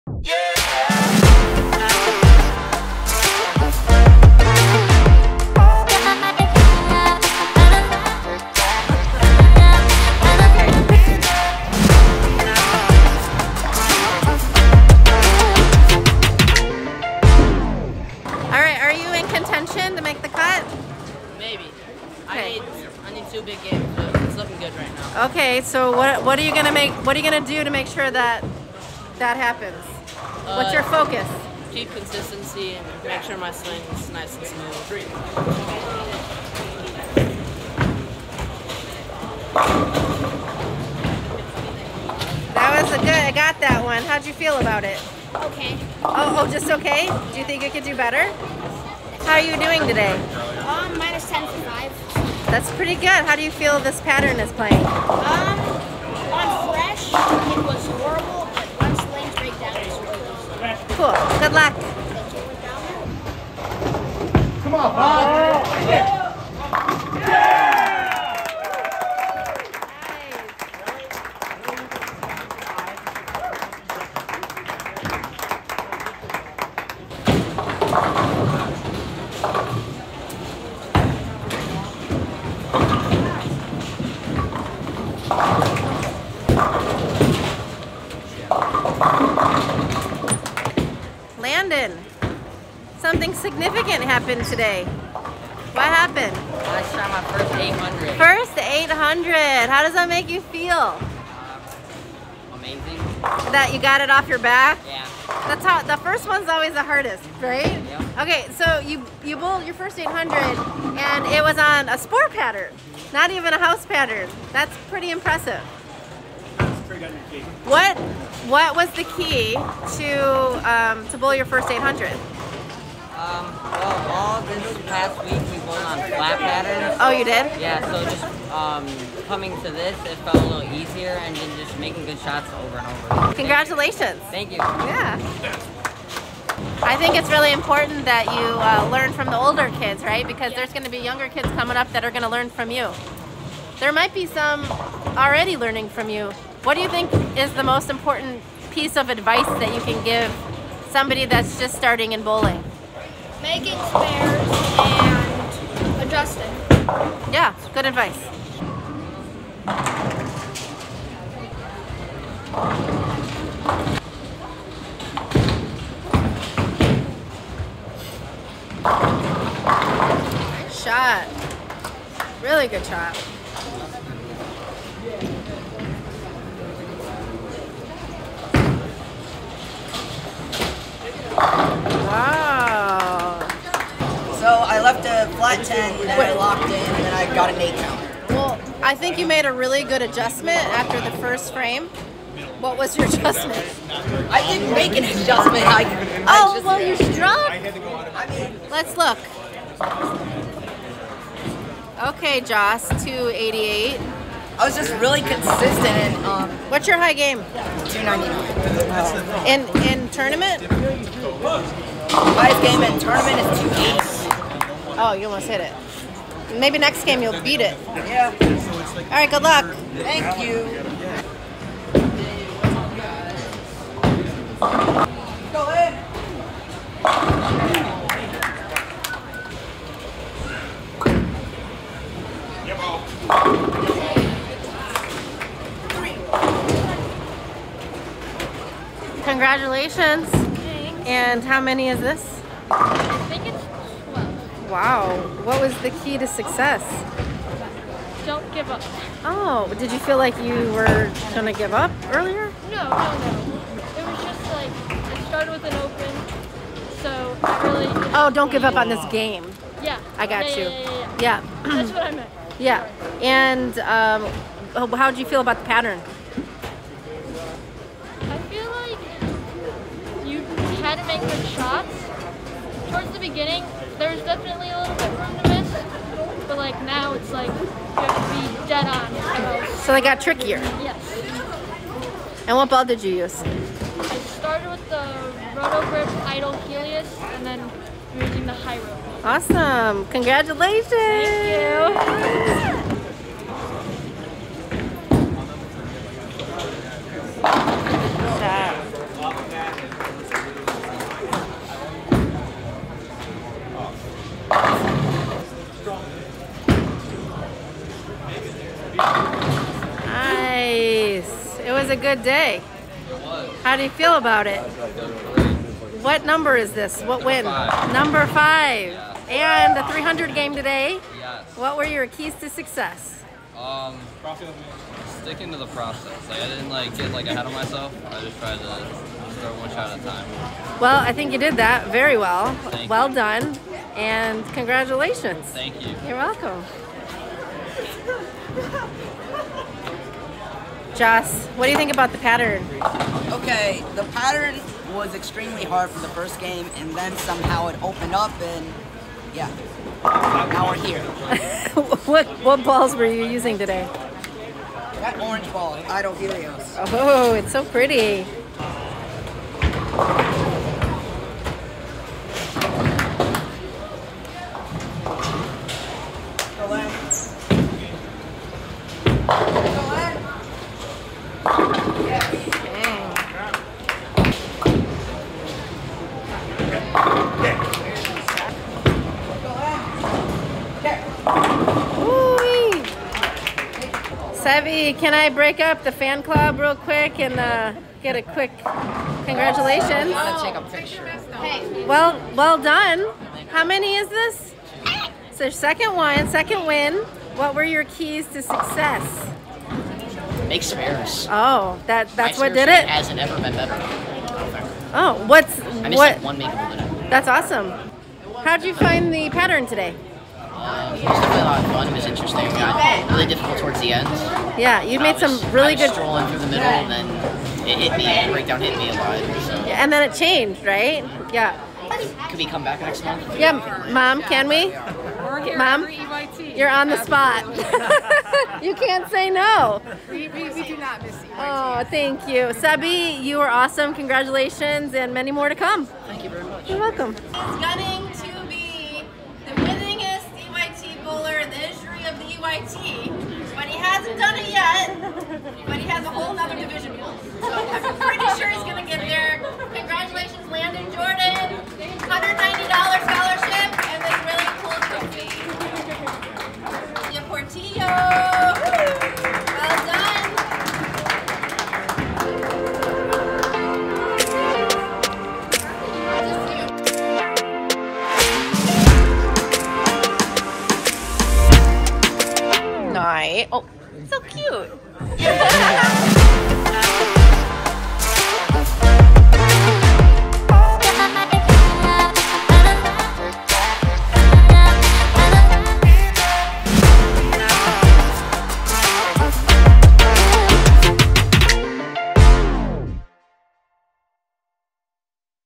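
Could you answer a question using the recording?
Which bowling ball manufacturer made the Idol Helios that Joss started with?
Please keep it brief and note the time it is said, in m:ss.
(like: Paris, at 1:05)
Roto Grip, at 4:45.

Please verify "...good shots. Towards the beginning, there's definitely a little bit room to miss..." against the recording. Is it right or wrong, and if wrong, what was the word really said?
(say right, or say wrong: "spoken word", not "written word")
right.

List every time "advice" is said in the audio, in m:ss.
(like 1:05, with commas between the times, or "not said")
2:29, 2:37.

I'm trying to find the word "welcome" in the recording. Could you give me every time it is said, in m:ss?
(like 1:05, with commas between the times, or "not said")
5:36, 7:16.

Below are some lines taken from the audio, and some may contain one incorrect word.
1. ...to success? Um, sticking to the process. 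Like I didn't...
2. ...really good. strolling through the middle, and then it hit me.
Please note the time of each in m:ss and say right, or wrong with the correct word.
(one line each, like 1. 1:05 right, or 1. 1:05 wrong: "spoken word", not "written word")
1. 5:22 right
2. 6:55 right.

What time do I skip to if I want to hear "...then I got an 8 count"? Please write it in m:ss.
3:07.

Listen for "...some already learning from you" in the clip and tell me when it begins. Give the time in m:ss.
2:24.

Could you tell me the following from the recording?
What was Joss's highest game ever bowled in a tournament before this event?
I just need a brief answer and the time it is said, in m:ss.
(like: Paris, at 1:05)
280, at 3:33.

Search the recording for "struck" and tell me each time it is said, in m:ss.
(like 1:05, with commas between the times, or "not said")
3:17.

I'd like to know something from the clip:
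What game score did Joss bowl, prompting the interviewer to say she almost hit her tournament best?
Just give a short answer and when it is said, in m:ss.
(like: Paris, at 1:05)
288, at 3:23.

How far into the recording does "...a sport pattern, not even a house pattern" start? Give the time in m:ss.
1:51.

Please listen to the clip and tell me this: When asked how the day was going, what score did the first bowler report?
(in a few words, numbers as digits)
minus 10 to 5.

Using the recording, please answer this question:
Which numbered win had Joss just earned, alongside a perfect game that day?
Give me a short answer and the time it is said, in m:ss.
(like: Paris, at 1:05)
5, at 5:18.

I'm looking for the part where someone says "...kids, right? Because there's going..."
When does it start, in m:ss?
2:19.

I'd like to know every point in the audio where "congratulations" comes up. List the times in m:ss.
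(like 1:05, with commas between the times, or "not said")
2:13, 3:59, 4:50, 5:34, 6:29, 7:13.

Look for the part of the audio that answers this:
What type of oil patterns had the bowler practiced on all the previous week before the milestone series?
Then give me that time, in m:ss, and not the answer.
2:06.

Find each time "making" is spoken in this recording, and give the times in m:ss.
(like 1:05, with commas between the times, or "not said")
2:11, 2:33.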